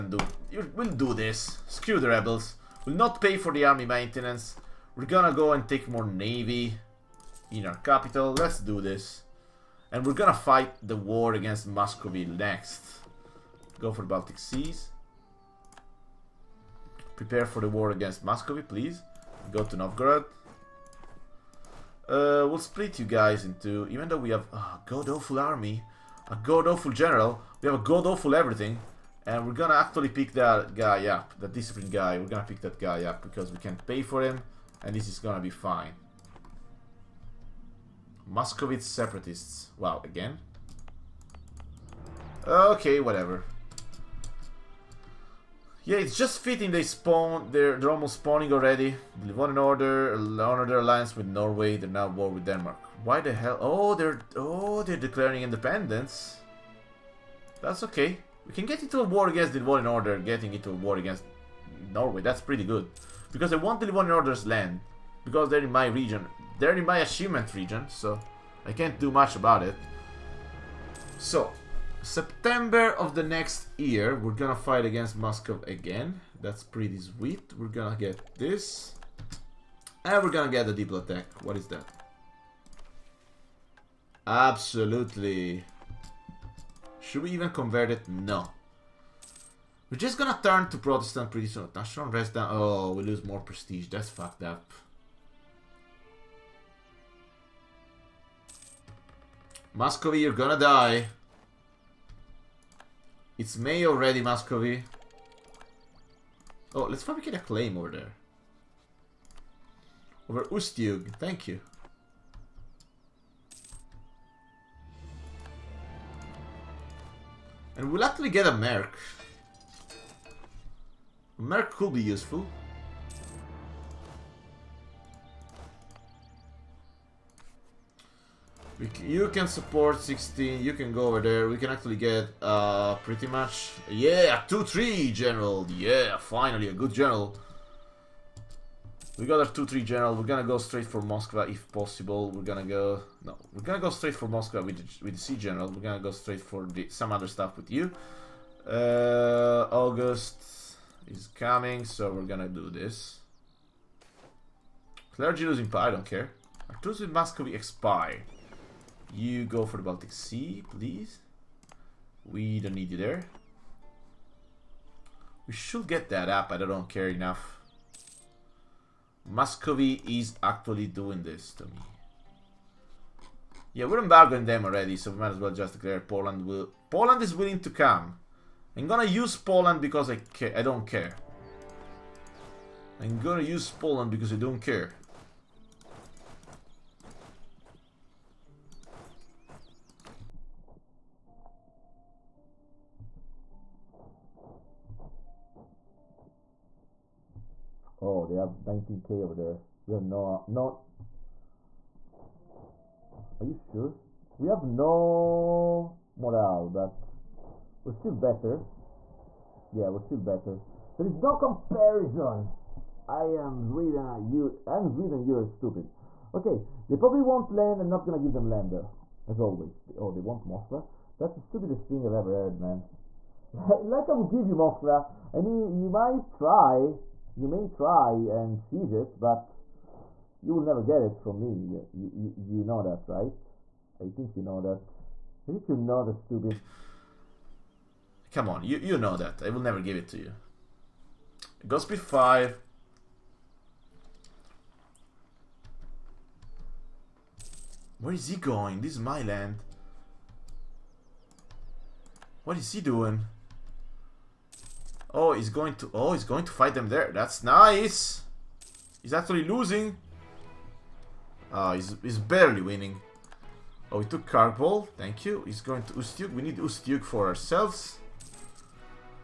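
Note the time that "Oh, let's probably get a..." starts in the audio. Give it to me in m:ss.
1:46.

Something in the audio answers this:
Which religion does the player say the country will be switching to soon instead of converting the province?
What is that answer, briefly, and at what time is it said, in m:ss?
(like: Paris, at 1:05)
Protestant, at 1:30.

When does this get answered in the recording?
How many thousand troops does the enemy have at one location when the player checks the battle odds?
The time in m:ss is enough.
3:18.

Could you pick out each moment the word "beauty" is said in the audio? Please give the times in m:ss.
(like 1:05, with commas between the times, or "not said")
not said.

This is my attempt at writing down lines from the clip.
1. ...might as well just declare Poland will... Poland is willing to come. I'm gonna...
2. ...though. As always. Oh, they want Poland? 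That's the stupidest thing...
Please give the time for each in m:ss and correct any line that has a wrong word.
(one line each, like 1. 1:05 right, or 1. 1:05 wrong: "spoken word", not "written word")
1. 2:55 right
2. 3:38 wrong: "Moscow", not "Poland".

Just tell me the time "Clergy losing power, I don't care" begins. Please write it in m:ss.
2:35.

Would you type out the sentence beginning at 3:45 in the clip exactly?
I mean, you might try, you may try and siege it, but you will never get it from me.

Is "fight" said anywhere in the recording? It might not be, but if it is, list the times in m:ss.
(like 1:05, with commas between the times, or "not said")
0:10, 1:14, 4:16.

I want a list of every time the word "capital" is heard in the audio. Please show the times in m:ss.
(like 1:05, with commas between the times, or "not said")
0:07.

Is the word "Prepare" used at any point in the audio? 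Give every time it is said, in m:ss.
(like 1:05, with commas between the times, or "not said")
0:17.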